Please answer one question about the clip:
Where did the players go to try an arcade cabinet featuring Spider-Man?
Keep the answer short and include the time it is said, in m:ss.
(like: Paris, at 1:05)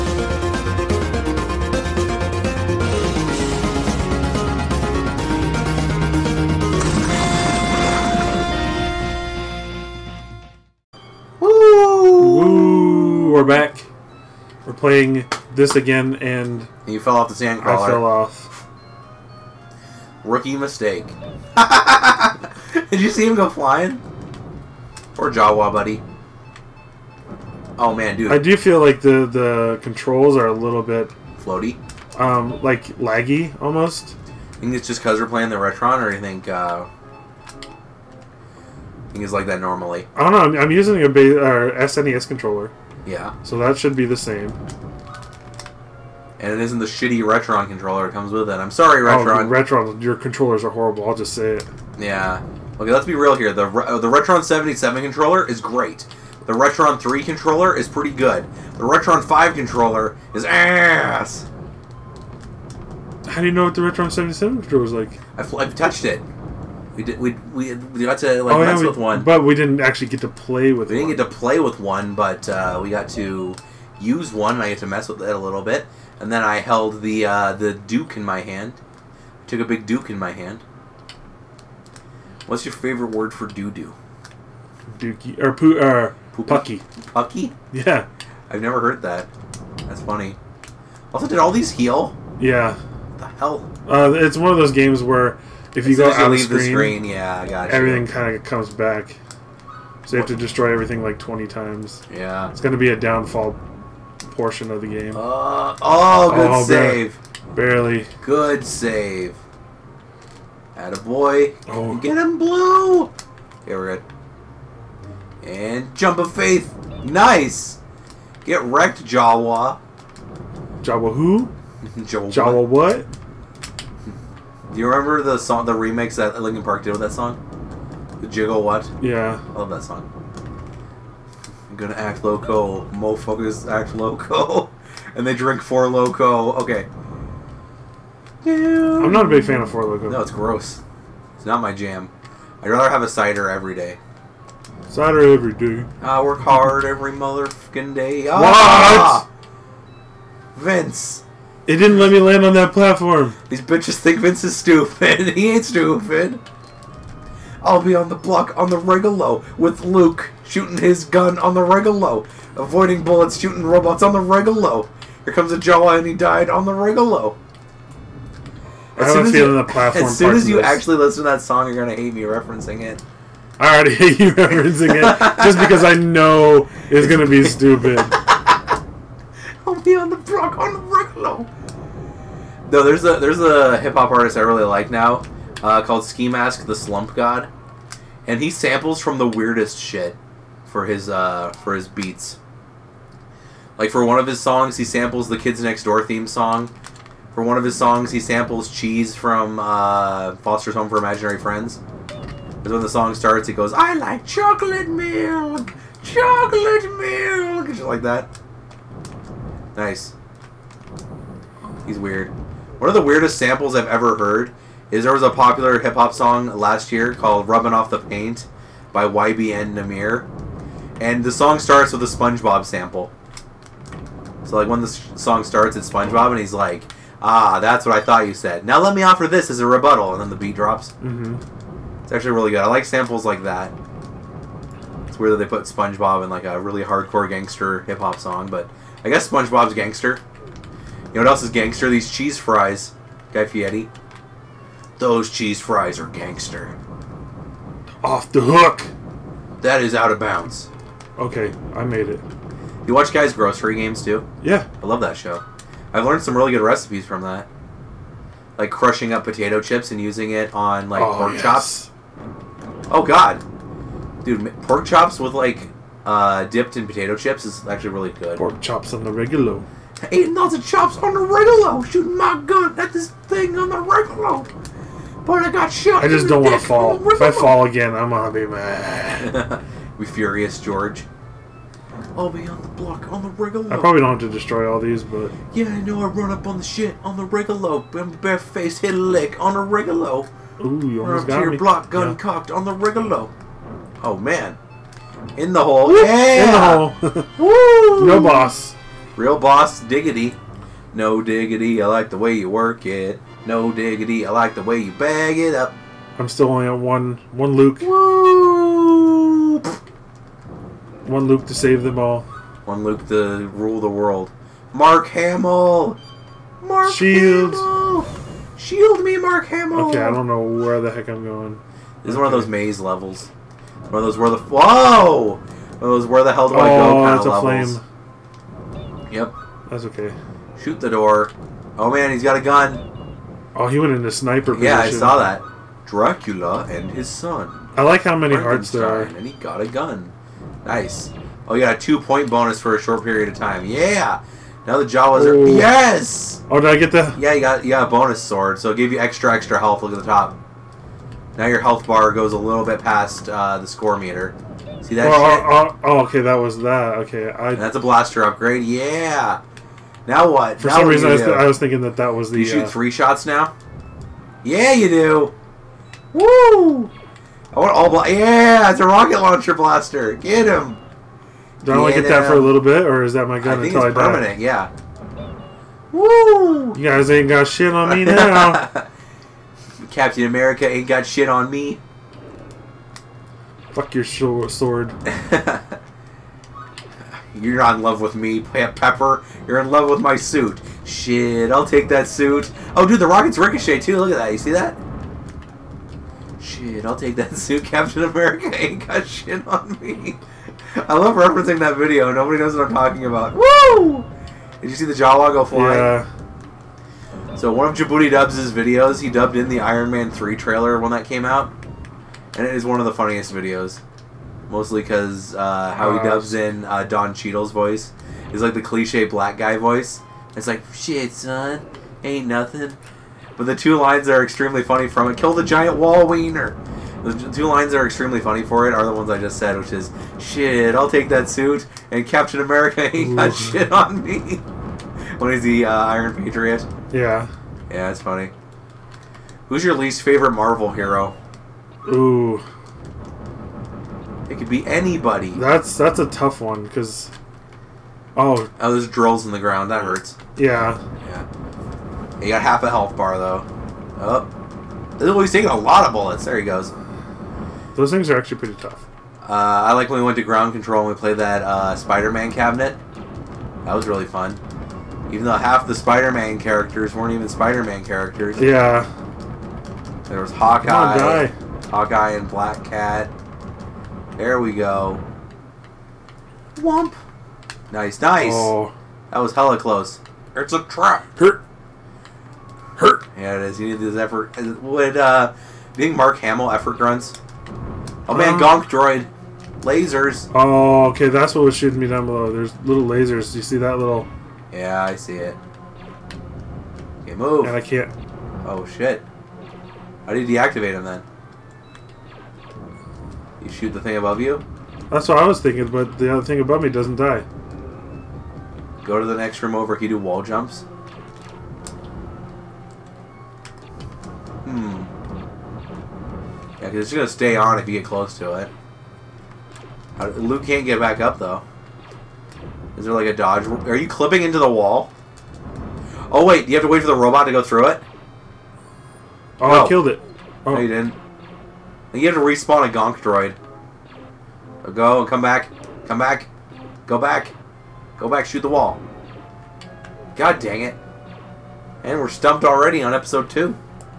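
Ground Control, at 7:40.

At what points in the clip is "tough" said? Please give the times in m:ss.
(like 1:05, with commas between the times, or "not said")
7:26, 7:38.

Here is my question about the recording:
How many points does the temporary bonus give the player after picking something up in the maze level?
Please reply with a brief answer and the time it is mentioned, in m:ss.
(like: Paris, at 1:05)
2, at 5:41.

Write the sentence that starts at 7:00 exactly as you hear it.
It's like shit, son, ain't nothing.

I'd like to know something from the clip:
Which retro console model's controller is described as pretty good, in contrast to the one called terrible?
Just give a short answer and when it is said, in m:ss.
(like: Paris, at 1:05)
Retron 3, at 0:56.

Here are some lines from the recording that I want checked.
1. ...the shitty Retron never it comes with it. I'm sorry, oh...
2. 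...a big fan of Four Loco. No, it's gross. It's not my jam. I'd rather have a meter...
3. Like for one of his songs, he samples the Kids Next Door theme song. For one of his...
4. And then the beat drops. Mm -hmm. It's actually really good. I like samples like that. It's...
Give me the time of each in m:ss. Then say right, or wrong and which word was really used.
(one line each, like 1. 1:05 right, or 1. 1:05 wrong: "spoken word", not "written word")
1. 0:46 wrong: "controller", not "never"
2. 2:19 wrong: "cider", not "meter"
3. 3:13 right
4. 3:50 right.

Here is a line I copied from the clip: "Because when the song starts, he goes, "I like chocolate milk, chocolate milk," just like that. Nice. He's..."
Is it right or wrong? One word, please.
right.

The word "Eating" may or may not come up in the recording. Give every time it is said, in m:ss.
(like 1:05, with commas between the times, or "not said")
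4:30.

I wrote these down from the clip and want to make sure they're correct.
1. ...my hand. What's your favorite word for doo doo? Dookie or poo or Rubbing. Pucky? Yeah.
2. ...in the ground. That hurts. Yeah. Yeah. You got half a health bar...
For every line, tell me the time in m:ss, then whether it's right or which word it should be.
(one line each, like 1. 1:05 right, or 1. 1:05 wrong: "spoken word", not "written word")
1. 1:20 wrong: "Pucky", not "Rubbing"
2. 7:29 right.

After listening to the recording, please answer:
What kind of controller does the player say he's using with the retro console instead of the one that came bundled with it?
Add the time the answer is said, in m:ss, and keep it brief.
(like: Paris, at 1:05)
SNES controller, at 0:42.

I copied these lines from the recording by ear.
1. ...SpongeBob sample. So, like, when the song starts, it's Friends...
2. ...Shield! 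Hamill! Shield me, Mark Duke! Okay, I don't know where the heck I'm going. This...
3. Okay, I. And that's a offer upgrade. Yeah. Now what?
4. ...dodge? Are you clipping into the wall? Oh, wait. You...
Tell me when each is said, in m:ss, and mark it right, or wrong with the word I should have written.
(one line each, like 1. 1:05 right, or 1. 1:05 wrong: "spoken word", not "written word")
1. 3:42 wrong: "SpongeBob", not "Friends"
2. 5:16 wrong: "Hamill", not "Duke"
3. 5:56 wrong: "blaster", not "offer"
4. 8:43 right.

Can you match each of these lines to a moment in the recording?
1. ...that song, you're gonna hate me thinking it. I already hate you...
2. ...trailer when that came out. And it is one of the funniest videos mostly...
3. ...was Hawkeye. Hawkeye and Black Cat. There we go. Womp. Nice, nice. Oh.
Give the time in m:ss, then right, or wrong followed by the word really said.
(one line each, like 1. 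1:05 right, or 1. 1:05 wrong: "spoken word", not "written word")
1. 2:51 wrong: "referencing", not "thinking"
2. 6:50 right
3. 7:50 right.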